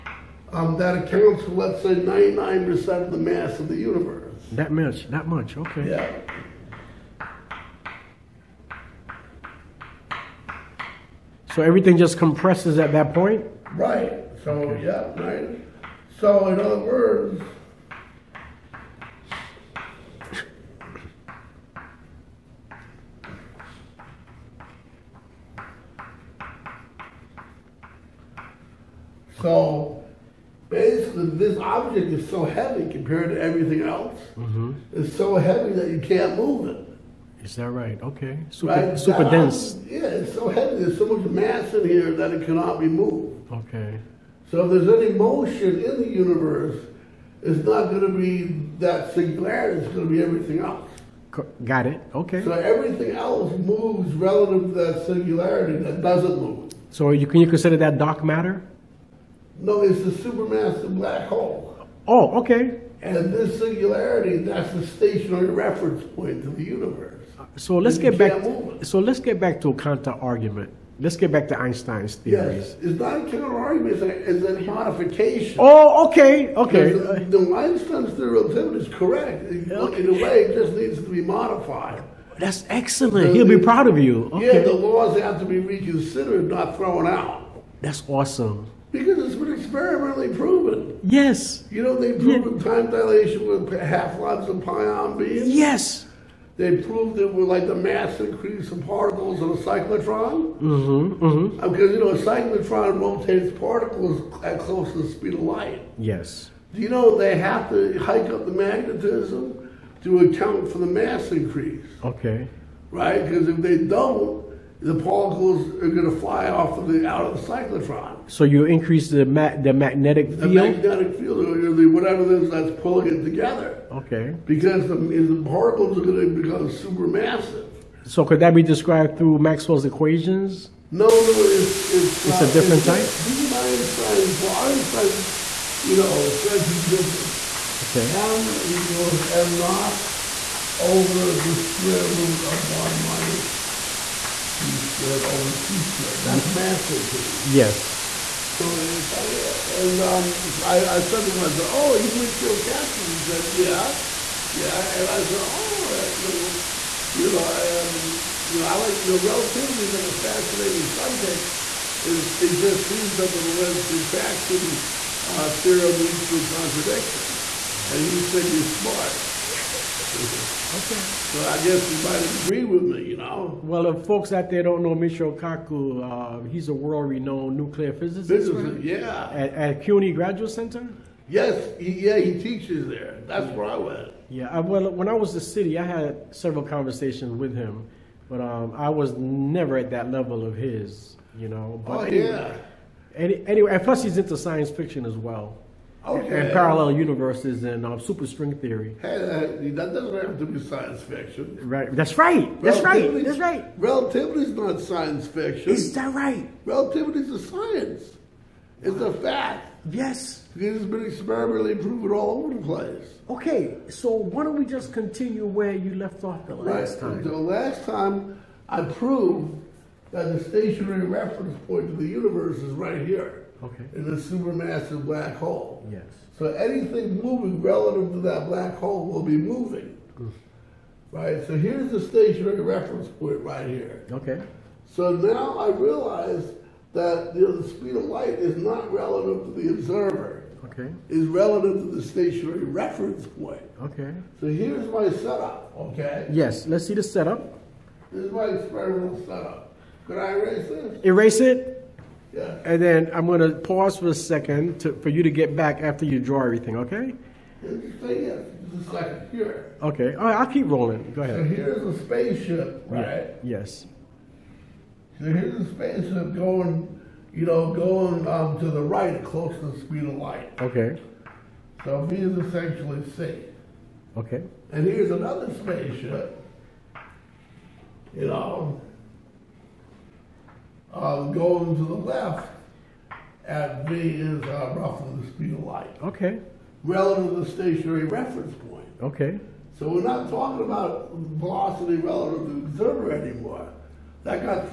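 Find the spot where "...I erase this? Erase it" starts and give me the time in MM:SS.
04:10.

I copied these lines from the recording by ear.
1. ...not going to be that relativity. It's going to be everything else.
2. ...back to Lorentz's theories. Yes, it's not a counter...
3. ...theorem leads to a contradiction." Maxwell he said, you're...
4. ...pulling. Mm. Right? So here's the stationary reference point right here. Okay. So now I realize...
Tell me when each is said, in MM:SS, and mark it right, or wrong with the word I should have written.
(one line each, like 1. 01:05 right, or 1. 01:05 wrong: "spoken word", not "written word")
1. 00:47 wrong: "singularity", not "relativity"
2. 01:11 wrong: "Einstein", not "Lorentz"
3. 02:45 wrong: "And", not "Maxwell"
4. 03:49 wrong: "moving", not "pulling".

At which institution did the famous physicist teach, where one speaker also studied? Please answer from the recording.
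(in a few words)
CUNY Graduate Center.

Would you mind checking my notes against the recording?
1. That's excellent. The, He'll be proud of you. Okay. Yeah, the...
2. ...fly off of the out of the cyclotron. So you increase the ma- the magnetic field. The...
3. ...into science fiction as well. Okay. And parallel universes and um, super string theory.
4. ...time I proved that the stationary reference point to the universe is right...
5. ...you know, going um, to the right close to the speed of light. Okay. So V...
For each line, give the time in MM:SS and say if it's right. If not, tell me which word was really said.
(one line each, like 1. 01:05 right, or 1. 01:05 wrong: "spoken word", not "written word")
1. 01:22 right
2. 01:56 right
3. 03:14 right
4. 03:37 right
5. 04:27 right.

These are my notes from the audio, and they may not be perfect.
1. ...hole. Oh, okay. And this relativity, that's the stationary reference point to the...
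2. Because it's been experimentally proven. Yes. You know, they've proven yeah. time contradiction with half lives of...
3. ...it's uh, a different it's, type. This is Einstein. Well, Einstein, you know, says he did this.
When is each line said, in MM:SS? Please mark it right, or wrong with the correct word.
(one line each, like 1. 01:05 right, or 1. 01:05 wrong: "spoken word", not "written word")
1. 01:01 wrong: "singularity", not "relativity"
2. 01:28 wrong: "dilation", not "contradiction"
3. 02:12 right.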